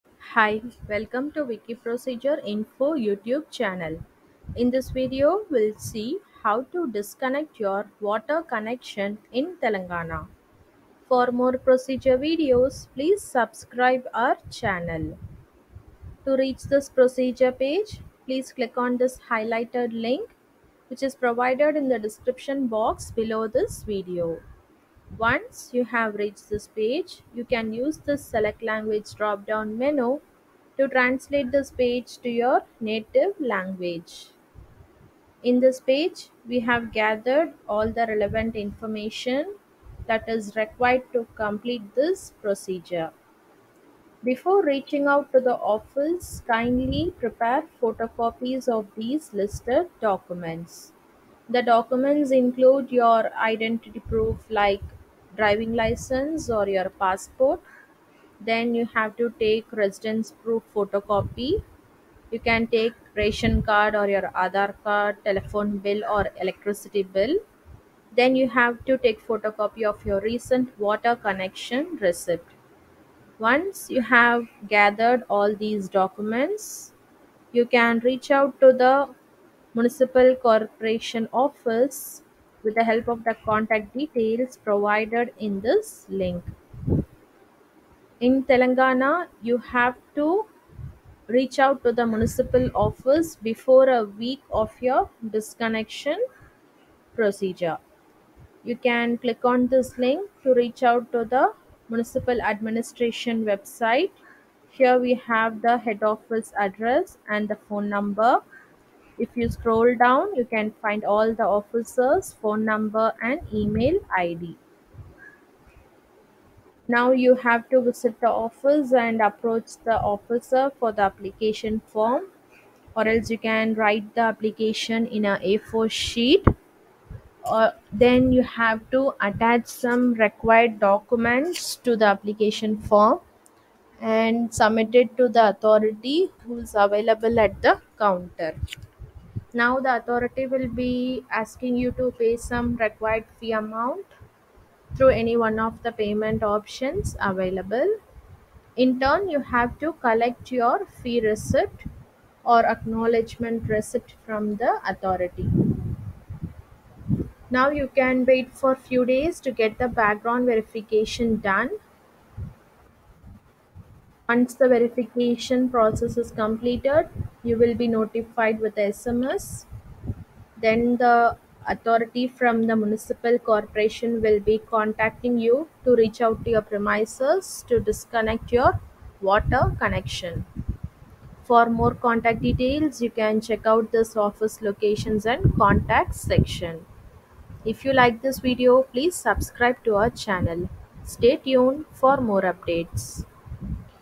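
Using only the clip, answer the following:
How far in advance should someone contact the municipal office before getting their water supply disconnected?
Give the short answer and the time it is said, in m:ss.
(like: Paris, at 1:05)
a week, at 1:33.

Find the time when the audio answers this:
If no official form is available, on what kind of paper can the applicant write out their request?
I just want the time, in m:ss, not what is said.
2:05.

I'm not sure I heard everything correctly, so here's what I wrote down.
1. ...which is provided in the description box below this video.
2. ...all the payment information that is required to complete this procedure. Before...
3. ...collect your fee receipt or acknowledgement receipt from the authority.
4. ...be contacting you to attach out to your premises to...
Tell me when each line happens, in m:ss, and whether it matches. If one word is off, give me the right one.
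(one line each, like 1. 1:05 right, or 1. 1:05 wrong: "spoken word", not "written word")
1. 0:20 right
2. 0:37 wrong: "relevant", not "payment"
3. 2:30 right
4. 2:54 wrong: "reach", not "attach".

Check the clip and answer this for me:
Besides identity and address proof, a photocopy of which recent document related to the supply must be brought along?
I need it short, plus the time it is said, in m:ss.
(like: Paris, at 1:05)
water connection receipt, at 1:10.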